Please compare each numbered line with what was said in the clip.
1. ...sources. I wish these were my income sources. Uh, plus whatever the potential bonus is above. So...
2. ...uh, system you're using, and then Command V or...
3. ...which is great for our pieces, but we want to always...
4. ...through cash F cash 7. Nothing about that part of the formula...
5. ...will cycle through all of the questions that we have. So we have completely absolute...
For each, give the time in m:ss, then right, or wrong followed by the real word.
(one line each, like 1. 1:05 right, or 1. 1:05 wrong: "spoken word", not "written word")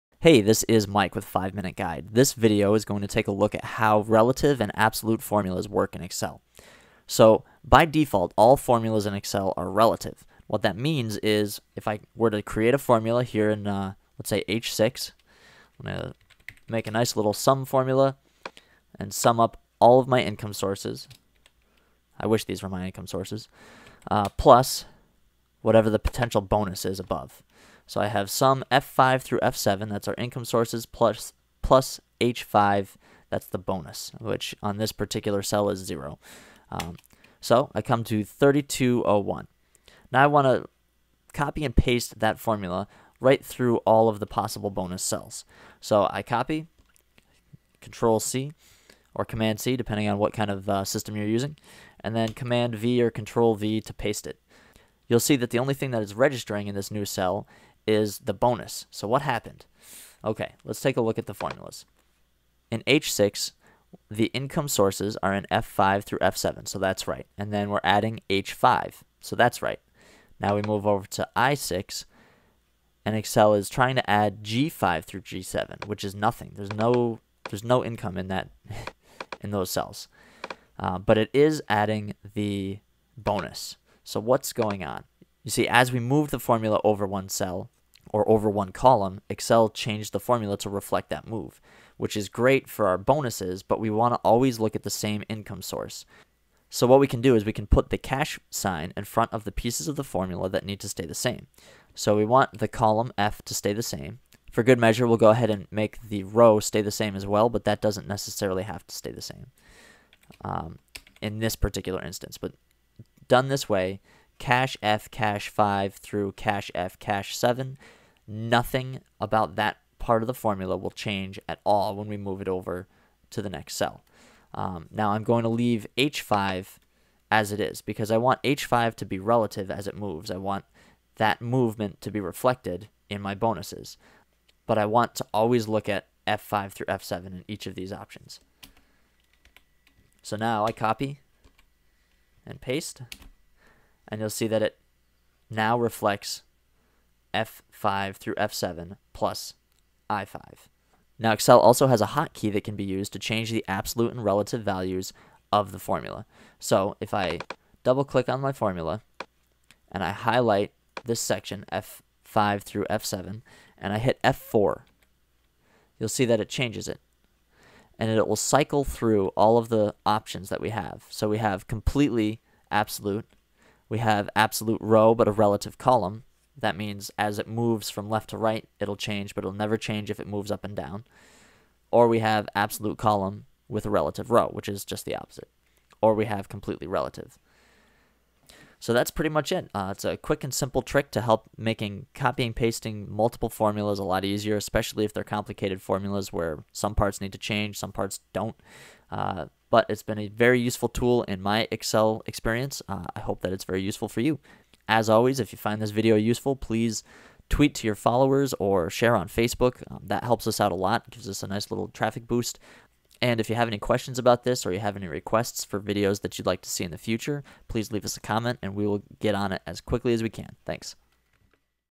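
1. 0:20 right
2. 0:50 right
3. 1:31 wrong: "bonuses", not "pieces"
4. 1:55 right
5. 2:48 wrong: "options", not "questions".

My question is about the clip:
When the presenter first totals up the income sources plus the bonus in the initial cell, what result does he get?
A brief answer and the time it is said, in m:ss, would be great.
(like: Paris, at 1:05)
3201, at 0:38.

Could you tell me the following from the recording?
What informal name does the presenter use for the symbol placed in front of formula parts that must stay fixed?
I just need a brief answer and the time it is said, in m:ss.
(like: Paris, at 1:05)
cash sign, at 1:37.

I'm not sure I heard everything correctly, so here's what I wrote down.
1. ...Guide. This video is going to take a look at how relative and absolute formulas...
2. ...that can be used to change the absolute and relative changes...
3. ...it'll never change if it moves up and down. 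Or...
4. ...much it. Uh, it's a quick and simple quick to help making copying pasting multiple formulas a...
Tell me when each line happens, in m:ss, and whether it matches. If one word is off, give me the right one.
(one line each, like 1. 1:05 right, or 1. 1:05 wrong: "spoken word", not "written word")
1. 0:01 right
2. 2:32 wrong: "values", not "changes"
3. 2:59 right
4. 3:09 wrong: "trick", not "quick".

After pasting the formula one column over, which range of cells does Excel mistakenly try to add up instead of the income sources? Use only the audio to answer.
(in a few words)
G5 through G7.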